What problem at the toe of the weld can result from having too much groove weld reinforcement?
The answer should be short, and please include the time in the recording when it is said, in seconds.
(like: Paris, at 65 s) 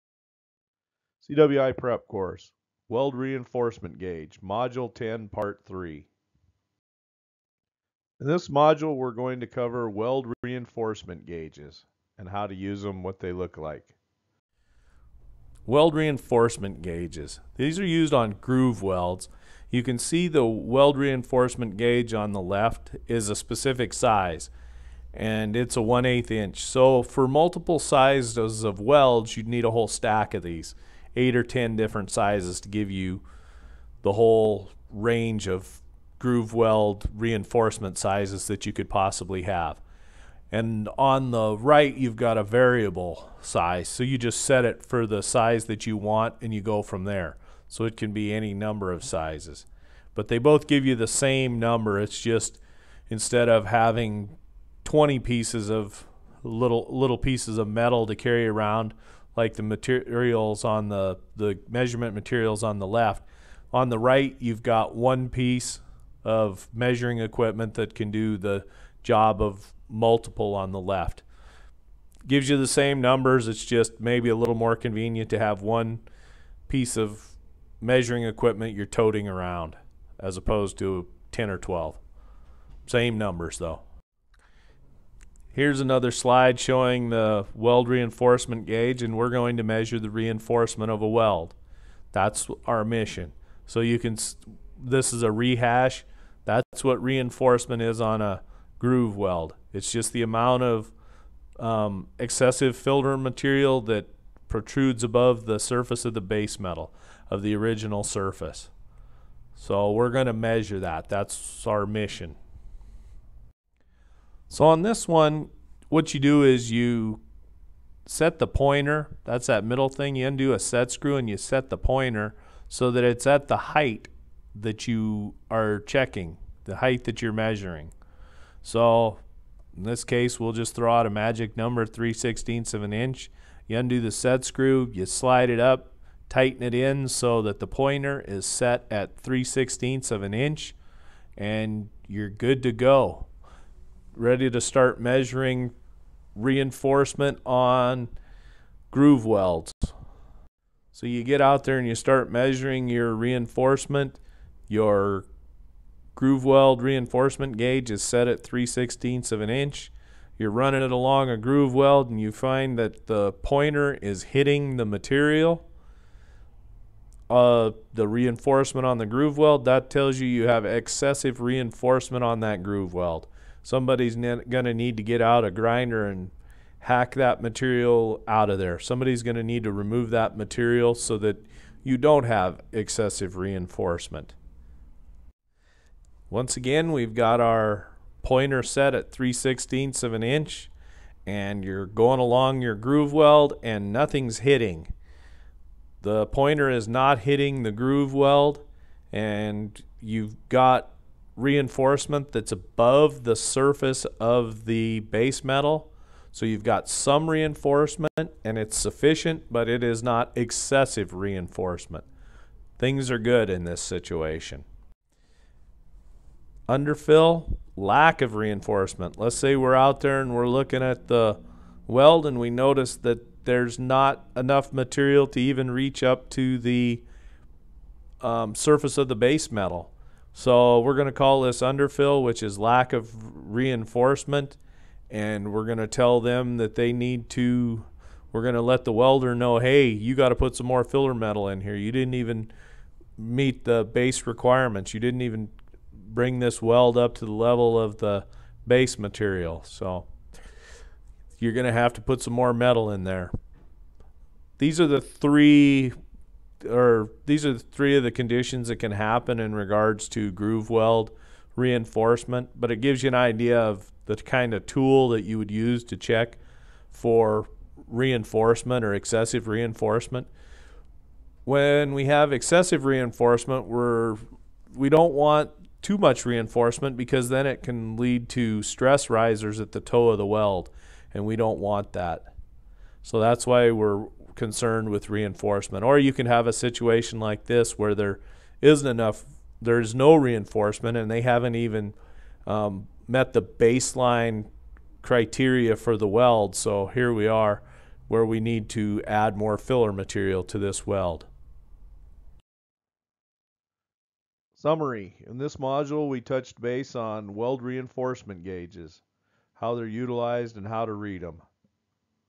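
stress risers, at 278 s.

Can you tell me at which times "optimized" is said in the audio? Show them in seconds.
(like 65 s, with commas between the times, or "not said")
not said.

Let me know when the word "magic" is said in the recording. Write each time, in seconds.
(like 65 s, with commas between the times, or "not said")
131 s.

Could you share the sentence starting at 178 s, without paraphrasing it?
Somebody's going to need to remove that material so that you don't have excessive reinforcement.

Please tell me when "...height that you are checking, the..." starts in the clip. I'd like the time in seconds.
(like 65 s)
123 s.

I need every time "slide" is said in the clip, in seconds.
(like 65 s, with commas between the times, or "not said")
86 s, 135 s.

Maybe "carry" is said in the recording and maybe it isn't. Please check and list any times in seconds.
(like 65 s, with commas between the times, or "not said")
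58 s.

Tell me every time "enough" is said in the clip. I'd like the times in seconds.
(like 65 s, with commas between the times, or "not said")
224 s, 288 s.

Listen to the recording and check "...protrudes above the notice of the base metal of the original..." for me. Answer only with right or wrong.
wrong.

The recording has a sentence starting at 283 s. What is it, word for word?
So that's why we're concerned with reinforcement.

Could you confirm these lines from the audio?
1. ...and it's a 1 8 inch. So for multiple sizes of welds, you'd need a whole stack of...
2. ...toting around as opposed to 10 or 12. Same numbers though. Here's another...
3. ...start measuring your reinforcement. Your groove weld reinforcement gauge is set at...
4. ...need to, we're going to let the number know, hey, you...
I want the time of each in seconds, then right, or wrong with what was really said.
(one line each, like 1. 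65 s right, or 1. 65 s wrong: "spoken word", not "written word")
1. 25 s right
2. 78 s right
3. 151 s right
4. 236 s wrong: "welder", not "number".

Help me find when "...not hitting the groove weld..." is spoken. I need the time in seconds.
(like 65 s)
196 s.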